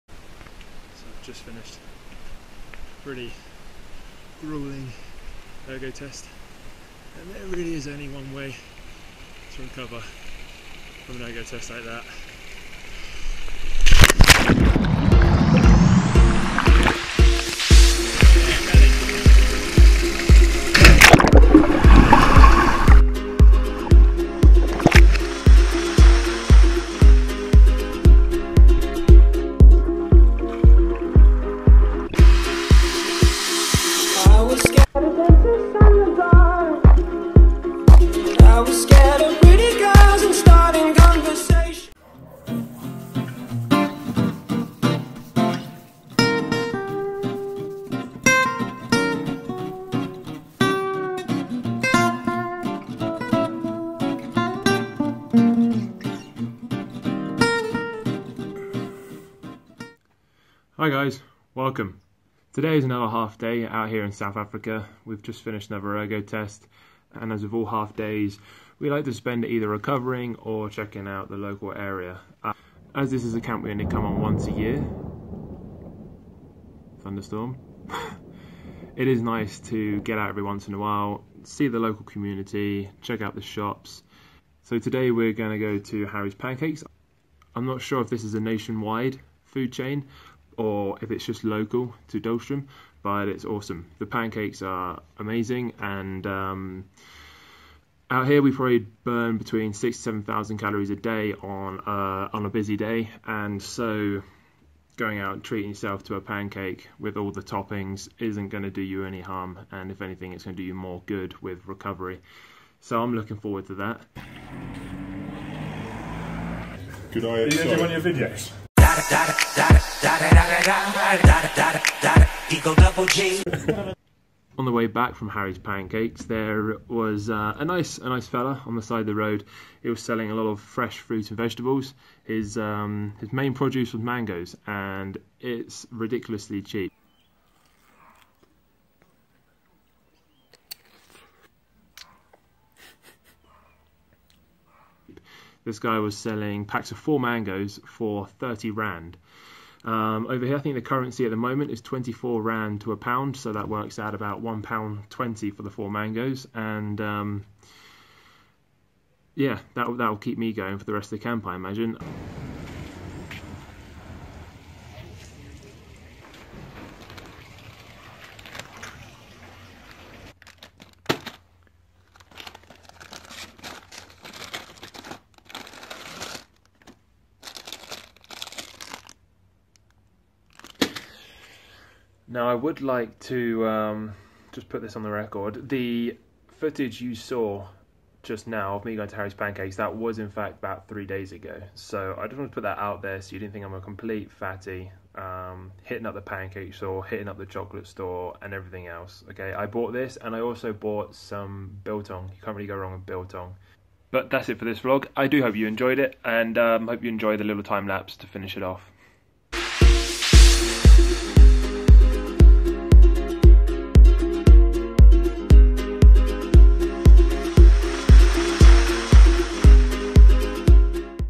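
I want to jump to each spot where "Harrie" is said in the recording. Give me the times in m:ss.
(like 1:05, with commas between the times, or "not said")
1:26, 2:05, 3:09.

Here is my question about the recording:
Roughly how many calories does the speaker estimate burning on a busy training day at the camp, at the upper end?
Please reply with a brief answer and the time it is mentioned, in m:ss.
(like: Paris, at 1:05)
7,000, at 1:40.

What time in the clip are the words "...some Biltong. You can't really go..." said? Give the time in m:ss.
3:21.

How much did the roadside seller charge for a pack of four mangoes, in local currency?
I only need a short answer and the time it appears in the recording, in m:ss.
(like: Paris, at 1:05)
30 rand, at 2:28.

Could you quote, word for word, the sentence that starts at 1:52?
So I'm looking forward to that.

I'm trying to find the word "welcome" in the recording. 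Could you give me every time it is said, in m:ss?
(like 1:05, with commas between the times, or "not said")
1:01.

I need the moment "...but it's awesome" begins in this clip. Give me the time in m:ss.
1:33.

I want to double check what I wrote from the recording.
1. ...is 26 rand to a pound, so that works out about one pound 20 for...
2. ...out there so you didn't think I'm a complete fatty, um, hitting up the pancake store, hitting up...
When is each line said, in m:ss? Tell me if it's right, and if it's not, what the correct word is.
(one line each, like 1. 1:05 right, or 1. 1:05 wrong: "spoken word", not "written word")
1. 2:31 wrong: "24", not "26"
2. 3:12 right.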